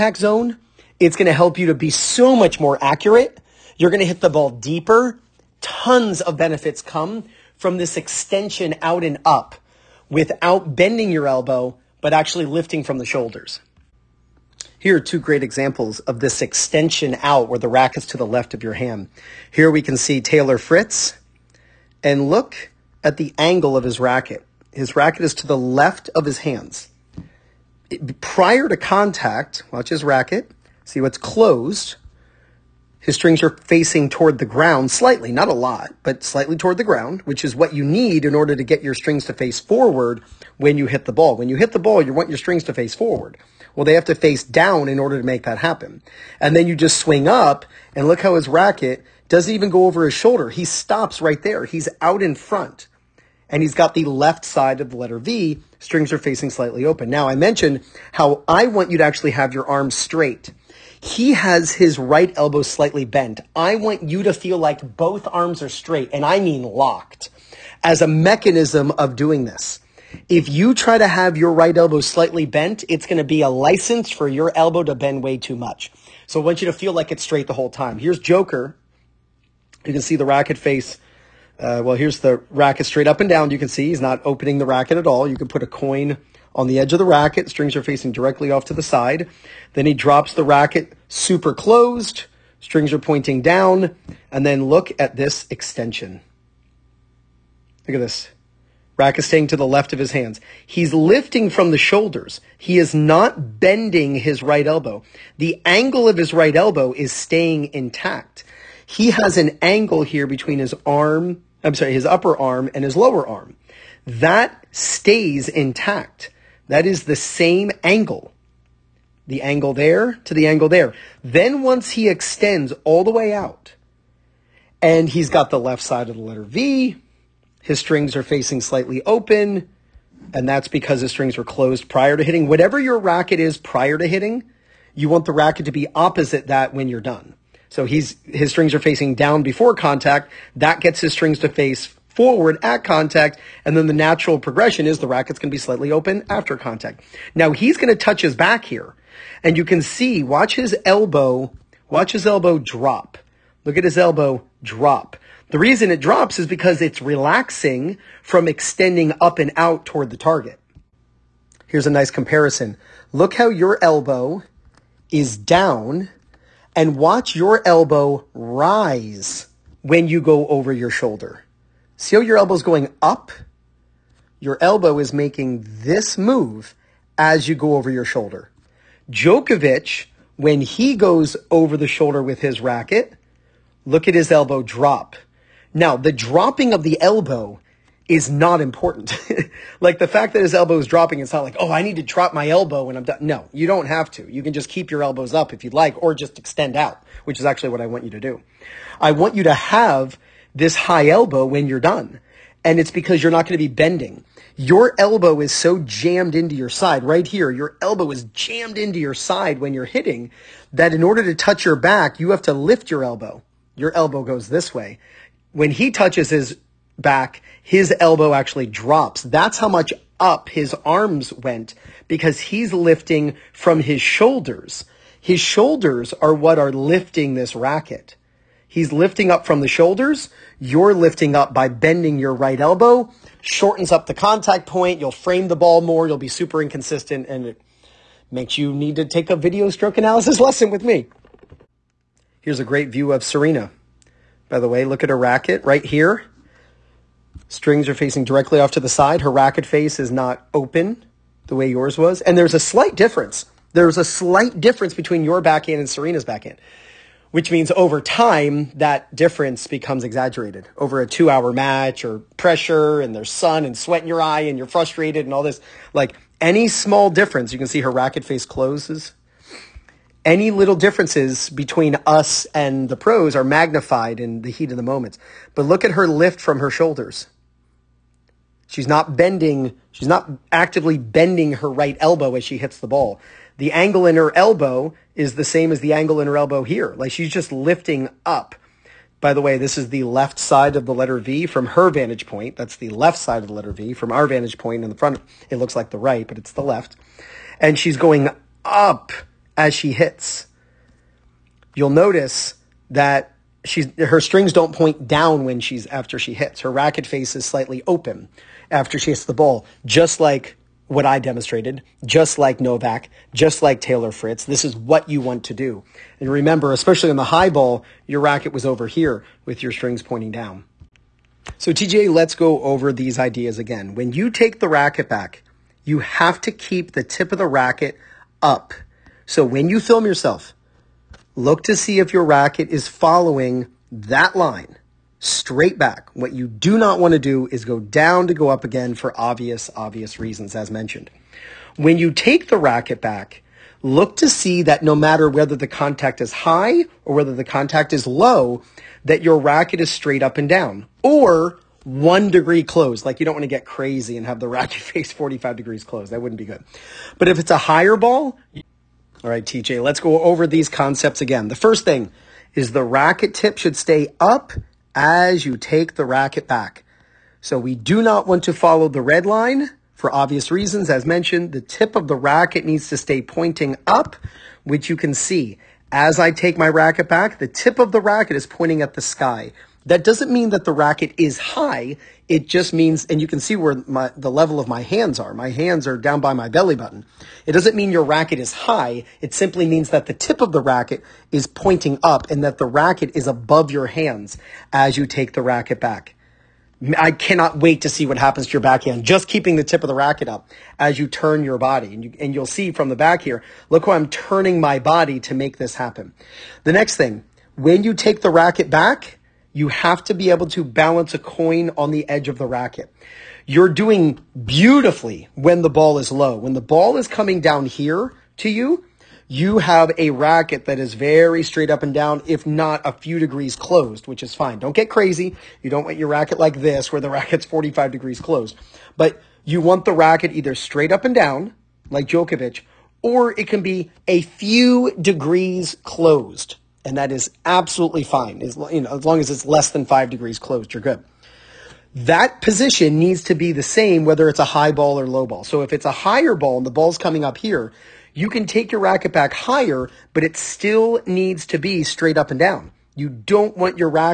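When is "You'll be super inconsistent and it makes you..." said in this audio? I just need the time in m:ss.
3:56.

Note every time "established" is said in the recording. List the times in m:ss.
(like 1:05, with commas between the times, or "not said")
not said.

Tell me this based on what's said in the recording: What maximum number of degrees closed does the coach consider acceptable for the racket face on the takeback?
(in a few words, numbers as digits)
5.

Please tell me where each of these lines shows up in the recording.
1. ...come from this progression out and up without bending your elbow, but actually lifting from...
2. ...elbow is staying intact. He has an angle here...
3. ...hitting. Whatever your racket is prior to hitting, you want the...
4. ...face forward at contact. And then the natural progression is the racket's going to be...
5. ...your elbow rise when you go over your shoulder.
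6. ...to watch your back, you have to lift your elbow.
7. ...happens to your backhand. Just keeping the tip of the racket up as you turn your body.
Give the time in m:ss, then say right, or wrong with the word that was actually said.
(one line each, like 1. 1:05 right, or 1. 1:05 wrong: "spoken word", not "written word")
1. 0:06 wrong: "extension", not "progression"
2. 1:46 right
3. 2:12 right
4. 2:21 right
5. 2:47 right
6. 3:31 wrong: "touch", not "watch"
7. 6:38 right.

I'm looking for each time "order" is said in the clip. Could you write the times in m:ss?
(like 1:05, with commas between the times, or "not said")
0:38, 0:44, 3:31.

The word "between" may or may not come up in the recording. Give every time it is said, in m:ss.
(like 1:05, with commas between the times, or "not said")
1:50, 4:14, 4:31.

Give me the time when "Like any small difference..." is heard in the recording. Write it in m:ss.
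4:25.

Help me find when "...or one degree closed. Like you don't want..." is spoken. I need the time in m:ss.
5:51.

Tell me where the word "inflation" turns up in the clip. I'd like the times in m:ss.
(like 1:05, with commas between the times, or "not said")
not said.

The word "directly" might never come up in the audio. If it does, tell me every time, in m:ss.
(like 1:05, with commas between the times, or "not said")
1:28, 4:08.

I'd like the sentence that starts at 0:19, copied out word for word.
Here we can see Taylor Fritz and look at the angle of his racket.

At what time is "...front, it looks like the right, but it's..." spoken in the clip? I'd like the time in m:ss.
4:54.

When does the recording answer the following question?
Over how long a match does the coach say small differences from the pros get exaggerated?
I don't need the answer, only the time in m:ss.
4:21.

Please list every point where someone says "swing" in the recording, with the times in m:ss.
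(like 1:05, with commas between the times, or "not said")
0:46.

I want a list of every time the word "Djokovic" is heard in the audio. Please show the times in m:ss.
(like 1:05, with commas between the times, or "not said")
2:59, 7:12.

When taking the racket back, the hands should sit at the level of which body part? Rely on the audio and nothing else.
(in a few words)
belly button.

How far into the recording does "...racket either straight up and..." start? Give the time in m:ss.
7:09.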